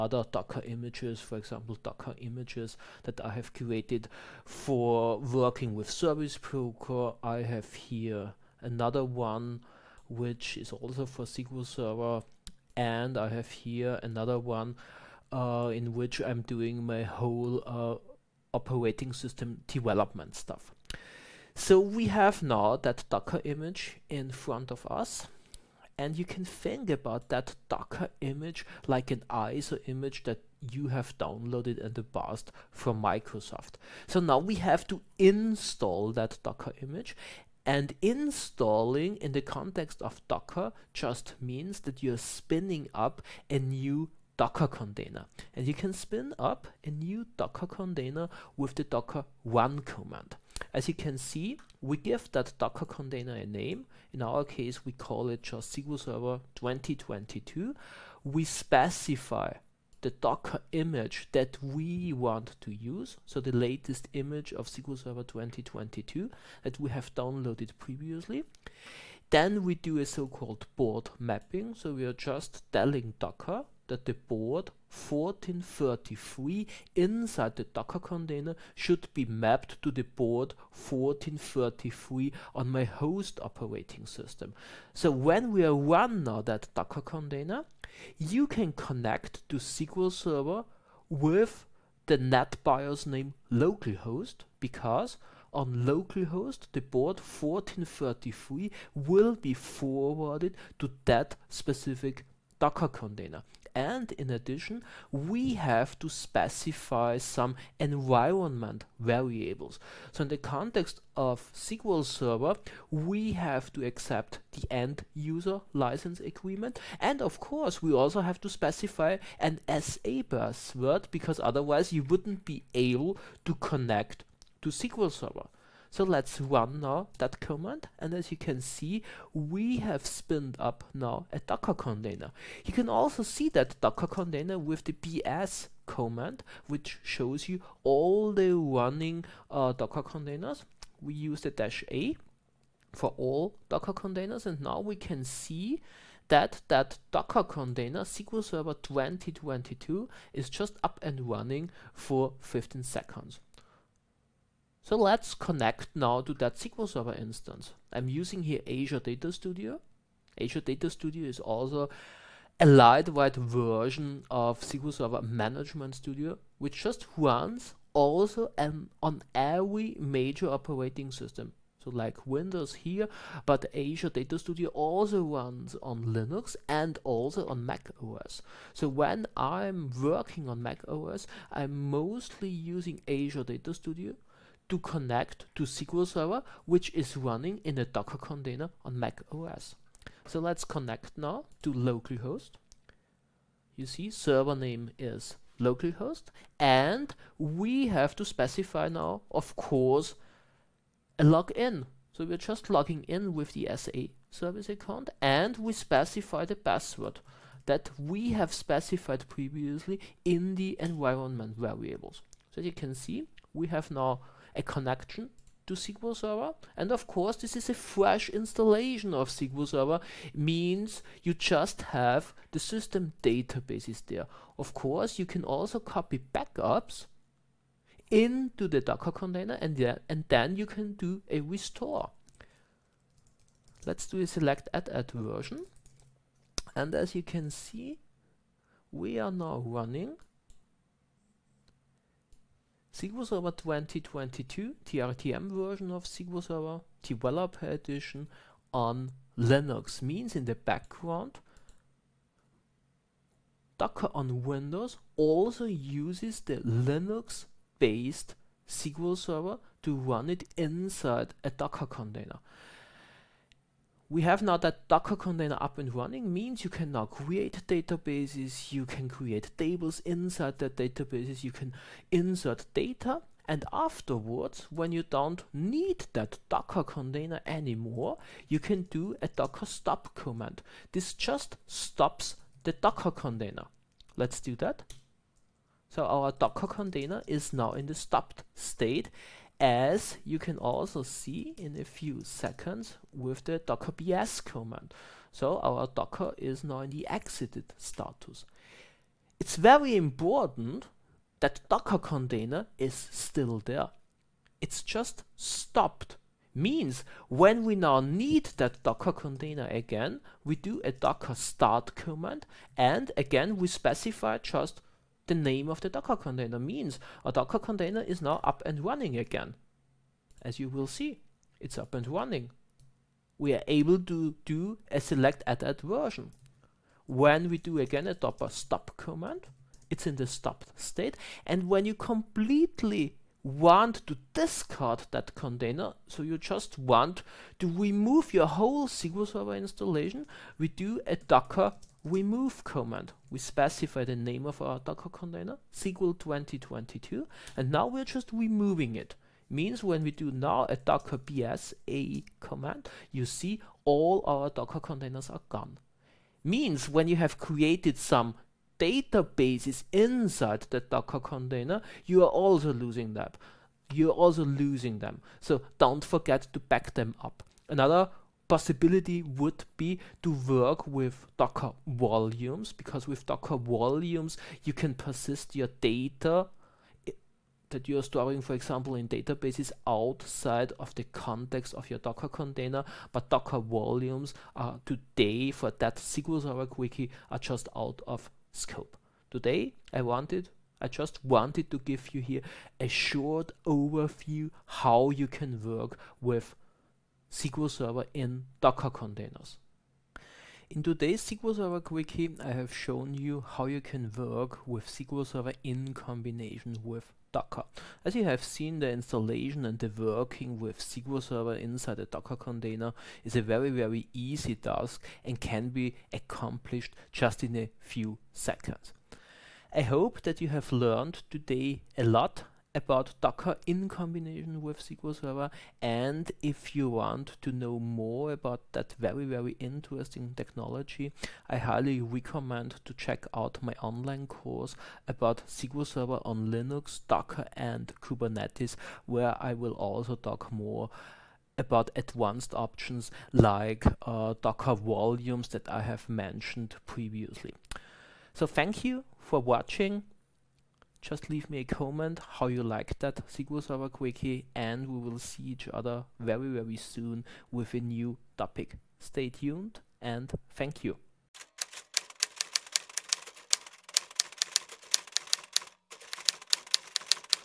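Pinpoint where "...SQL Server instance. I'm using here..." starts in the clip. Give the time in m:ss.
2:36.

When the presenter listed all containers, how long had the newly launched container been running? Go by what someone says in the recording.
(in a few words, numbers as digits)
15 seconds.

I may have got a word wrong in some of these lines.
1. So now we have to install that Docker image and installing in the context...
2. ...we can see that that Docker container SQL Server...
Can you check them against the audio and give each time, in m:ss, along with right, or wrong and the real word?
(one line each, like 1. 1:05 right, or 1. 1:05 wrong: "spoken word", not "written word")
1. 0:34 right
2. 2:24 right.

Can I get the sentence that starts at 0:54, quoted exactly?
In our case, we call it just SQL Server 2022.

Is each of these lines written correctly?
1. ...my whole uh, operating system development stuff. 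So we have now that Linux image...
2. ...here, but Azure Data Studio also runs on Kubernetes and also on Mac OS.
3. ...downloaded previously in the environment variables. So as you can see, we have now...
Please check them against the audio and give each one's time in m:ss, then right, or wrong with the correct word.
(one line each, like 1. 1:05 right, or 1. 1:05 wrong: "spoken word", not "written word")
1. 0:16 wrong: "Docker", not "Linux"
2. 2:52 wrong: "Linux", not "Kubernetes"
3. 3:28 wrong: "specified", not "downloaded".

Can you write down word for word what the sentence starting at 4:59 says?
It's very important that docker container is still there.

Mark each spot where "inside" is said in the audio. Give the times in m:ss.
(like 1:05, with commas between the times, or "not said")
1:16, 4:20, 4:30, 5:59, 6:51.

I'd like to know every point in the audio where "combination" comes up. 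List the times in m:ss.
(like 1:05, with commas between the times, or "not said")
6:45, 7:03.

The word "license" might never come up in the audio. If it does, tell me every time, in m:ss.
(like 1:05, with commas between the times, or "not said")
1:55.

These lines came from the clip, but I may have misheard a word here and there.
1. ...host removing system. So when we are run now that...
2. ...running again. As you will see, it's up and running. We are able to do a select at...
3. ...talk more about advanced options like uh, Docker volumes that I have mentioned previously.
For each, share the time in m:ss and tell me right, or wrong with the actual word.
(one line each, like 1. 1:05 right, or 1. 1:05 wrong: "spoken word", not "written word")
1. 1:22 wrong: "operating", not "removing"
2. 5:18 right
3. 7:20 right.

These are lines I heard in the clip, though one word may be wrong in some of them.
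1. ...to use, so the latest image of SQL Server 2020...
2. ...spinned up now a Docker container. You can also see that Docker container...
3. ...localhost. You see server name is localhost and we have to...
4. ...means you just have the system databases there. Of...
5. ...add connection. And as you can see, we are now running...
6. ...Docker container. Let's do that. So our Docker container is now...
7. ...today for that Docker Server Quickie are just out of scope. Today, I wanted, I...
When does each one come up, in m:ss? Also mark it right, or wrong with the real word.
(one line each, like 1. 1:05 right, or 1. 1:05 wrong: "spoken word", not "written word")
1. 1:02 wrong: "2022", not "2020"
2. 2:10 right
3. 3:11 right
4. 3:40 right
5. 3:54 wrong: "version", not "connection"
6. 4:42 right
7. 6:24 wrong: "SQL", not "Docker".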